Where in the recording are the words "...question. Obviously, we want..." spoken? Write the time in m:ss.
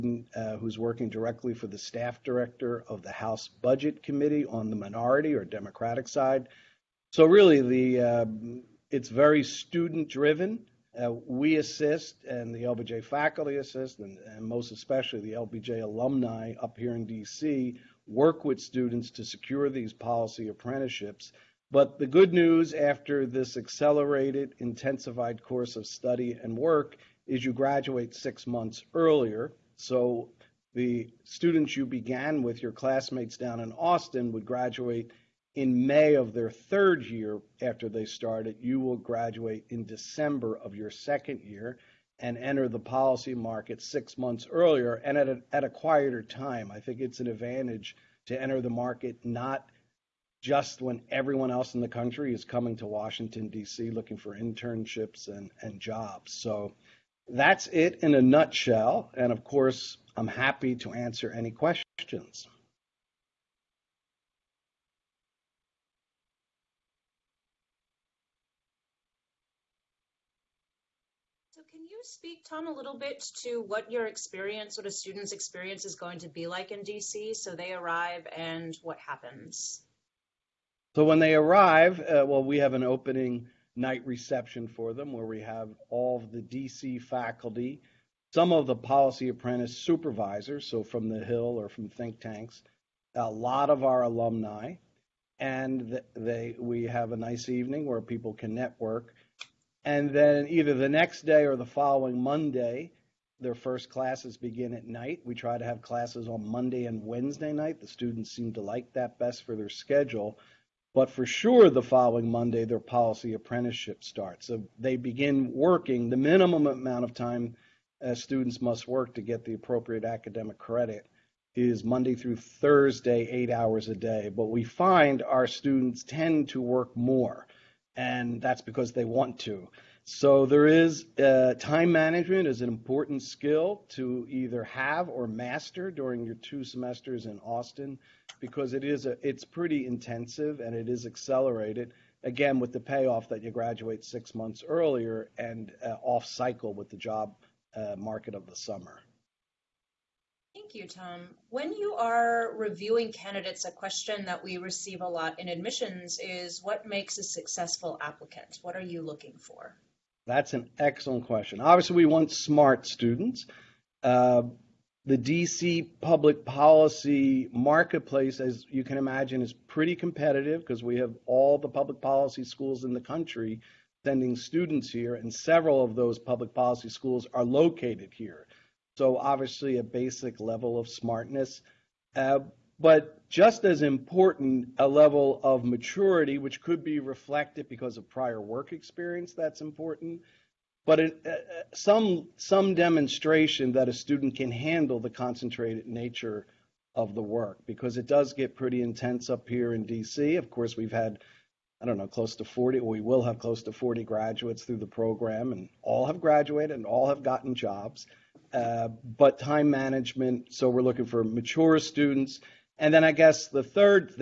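2:41.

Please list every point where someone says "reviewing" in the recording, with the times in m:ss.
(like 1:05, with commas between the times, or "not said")
2:32.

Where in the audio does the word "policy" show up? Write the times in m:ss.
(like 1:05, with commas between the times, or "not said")
0:19, 0:42, 1:28, 1:52, 2:46, 2:51, 2:56.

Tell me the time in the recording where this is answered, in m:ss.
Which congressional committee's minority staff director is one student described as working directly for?
0:03.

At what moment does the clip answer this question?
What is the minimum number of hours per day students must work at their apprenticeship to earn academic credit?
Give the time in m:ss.
2:03.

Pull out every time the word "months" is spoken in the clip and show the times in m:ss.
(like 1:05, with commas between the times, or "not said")
0:28, 0:44, 2:24.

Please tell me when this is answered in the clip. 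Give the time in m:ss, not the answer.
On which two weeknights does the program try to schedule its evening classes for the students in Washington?
1:46.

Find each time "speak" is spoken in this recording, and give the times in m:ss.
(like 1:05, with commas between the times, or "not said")
1:12.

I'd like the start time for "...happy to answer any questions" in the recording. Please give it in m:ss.
1:00.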